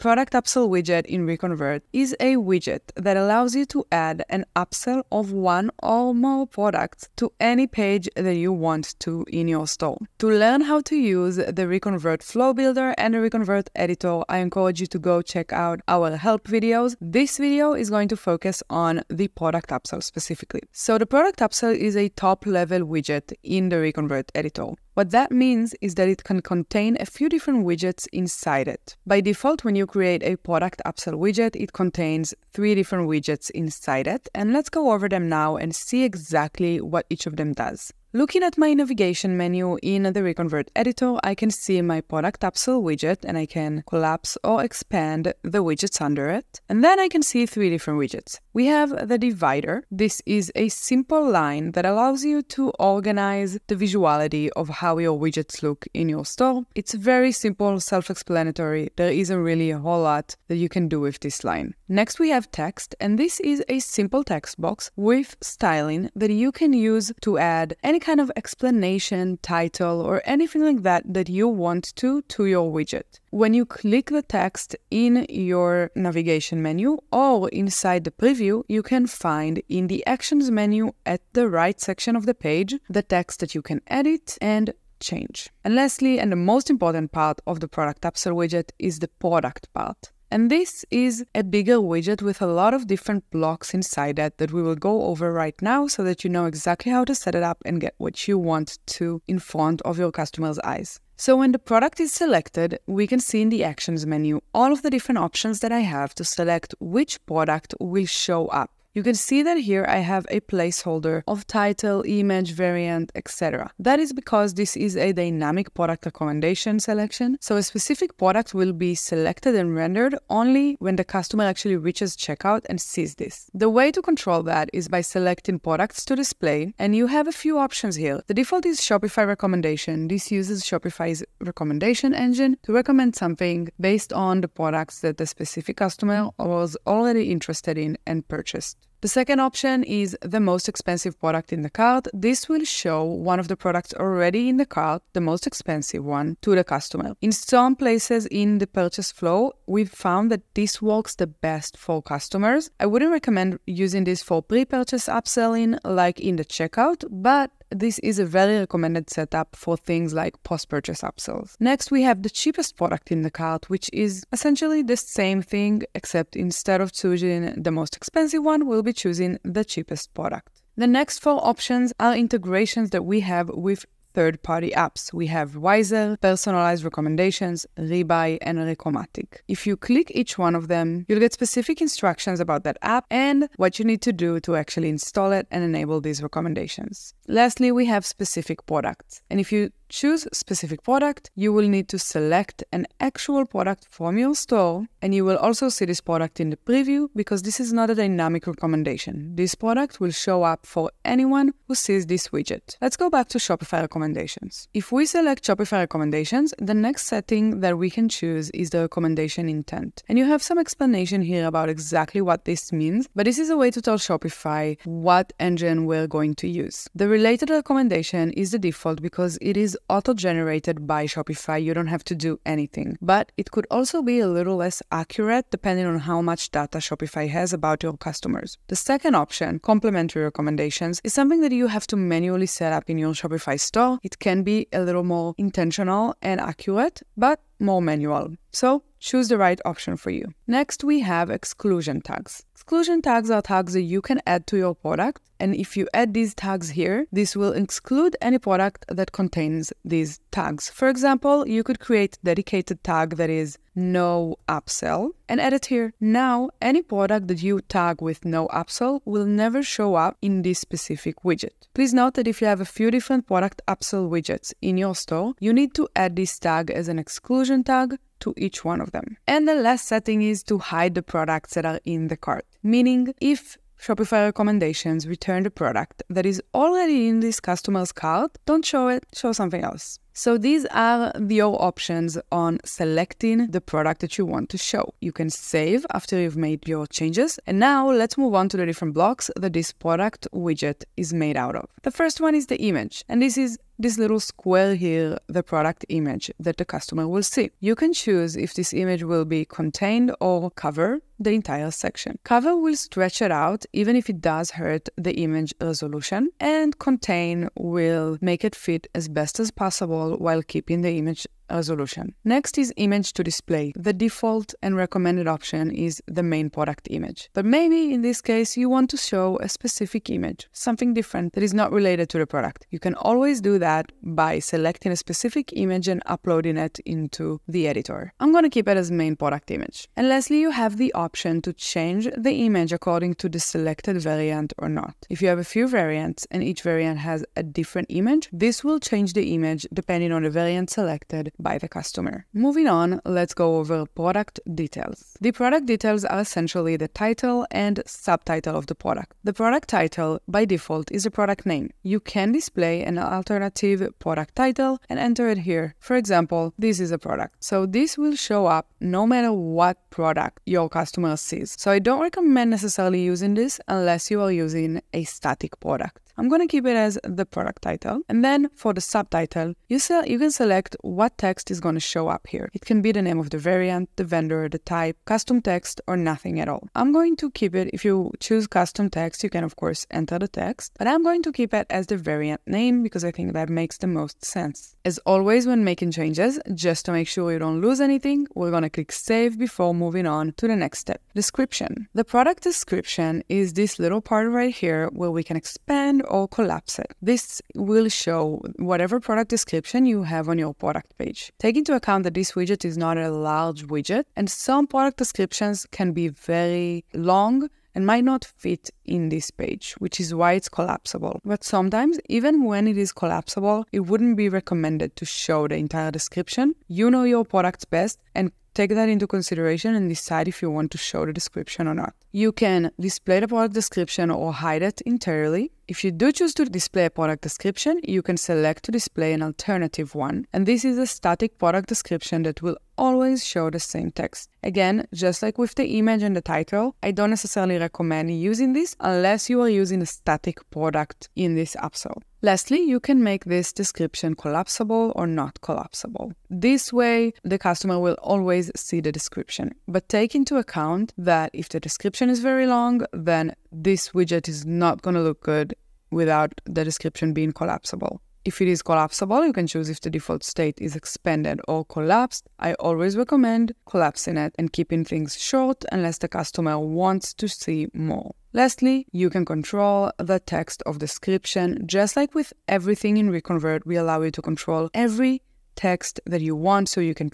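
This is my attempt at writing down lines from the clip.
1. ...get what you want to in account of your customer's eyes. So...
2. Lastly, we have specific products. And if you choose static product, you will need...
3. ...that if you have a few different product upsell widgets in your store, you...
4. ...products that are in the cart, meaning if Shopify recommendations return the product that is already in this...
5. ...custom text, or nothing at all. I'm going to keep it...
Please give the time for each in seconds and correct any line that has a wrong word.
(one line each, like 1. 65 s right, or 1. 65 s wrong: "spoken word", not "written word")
1. 97 s wrong: "front", not "account"
2. 187 s wrong: "specific", not "static"
3. 262 s right
4. 271 s right
5. 375 s right.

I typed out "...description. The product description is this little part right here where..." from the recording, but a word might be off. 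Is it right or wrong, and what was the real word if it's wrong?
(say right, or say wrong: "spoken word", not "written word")
right.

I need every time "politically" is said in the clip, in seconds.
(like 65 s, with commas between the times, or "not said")
not said.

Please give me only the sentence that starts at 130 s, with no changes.
This uses Shopify's recommendation engine to recommend something based on the products that the specific customer was already interested in and purchased.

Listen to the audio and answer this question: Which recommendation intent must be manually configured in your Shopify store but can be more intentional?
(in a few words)
Complementary recommendations.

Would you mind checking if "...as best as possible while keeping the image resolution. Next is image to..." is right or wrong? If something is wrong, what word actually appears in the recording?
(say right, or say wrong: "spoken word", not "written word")
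right.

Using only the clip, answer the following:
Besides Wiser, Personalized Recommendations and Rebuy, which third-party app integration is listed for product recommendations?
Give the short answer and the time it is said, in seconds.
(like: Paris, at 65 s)
Recomatic, at 178 s.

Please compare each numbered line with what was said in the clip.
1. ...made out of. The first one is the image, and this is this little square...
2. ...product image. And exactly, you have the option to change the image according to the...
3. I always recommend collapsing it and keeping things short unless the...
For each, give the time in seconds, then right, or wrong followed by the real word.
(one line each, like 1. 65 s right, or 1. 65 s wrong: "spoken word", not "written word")
1. 291 s right
2. 329 s wrong: "lastly", not "exactly"
3. 462 s right.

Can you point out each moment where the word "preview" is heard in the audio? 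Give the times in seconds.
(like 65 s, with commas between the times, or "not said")
78 s, 196 s.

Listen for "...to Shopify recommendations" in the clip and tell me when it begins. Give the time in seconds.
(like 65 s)
203 s.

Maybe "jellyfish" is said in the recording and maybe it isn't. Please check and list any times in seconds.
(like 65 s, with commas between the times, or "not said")
not said.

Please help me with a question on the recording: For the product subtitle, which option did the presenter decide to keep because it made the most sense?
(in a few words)
Variant name.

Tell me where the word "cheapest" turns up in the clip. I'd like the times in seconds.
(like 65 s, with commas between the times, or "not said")
162 s, 169 s.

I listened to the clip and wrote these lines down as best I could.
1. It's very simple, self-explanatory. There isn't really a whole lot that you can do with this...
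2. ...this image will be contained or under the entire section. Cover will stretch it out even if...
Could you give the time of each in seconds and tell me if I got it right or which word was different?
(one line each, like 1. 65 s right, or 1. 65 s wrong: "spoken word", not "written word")
1. 56 s right
2. 298 s wrong: "cover", not "under".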